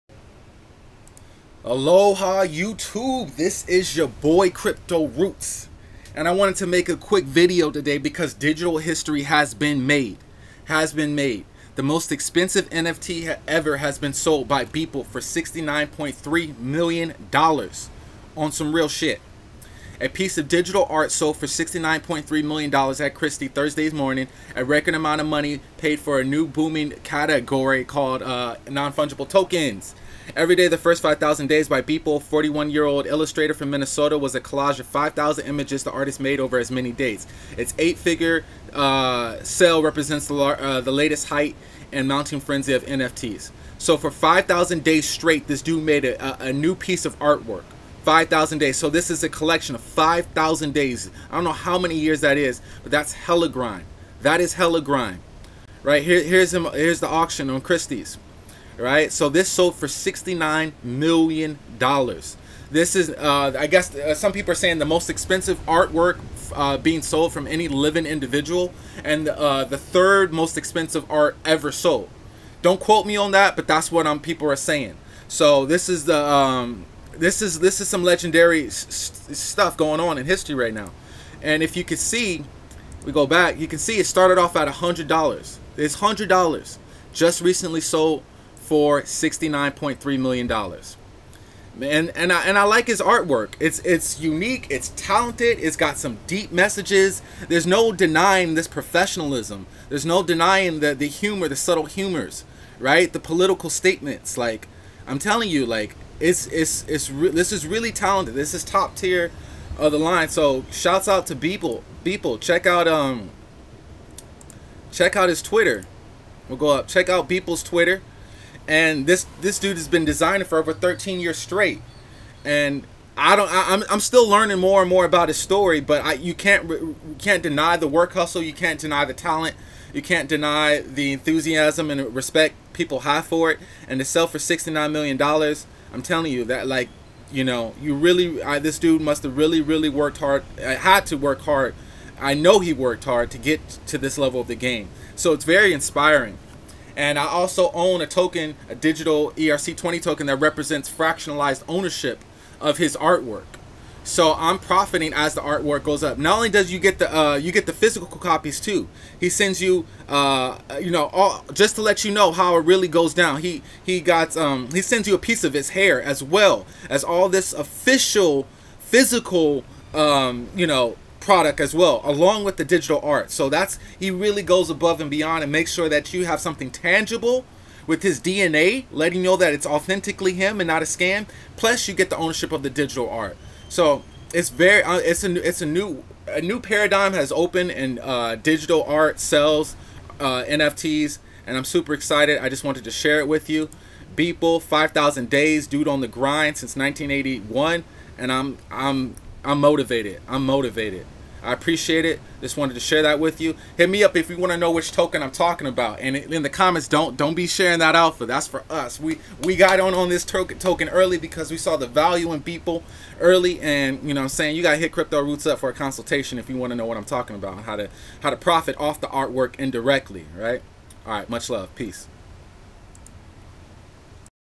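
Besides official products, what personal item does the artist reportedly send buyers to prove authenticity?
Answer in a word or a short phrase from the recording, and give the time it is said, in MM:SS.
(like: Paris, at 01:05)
A piece of his hair, at 02:45.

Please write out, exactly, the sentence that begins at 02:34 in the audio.
So I'm profiting as the artwork goes up.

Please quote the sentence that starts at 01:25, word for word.
It's $100 just recently sold for $69.3 million.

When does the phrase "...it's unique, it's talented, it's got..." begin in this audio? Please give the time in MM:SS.
01:33.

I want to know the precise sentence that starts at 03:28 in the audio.
We we got on on this token token early because we saw the value in Beeple early.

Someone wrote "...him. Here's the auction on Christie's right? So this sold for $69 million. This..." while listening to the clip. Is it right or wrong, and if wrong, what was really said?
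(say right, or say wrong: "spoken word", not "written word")
right.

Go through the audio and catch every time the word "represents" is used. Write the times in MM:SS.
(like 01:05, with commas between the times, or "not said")
00:39, 02:30.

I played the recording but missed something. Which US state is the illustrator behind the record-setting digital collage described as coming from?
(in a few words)
Minnesota.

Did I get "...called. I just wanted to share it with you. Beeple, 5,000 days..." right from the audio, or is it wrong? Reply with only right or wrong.
wrong.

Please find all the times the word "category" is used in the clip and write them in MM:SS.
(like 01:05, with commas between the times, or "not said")
00:27.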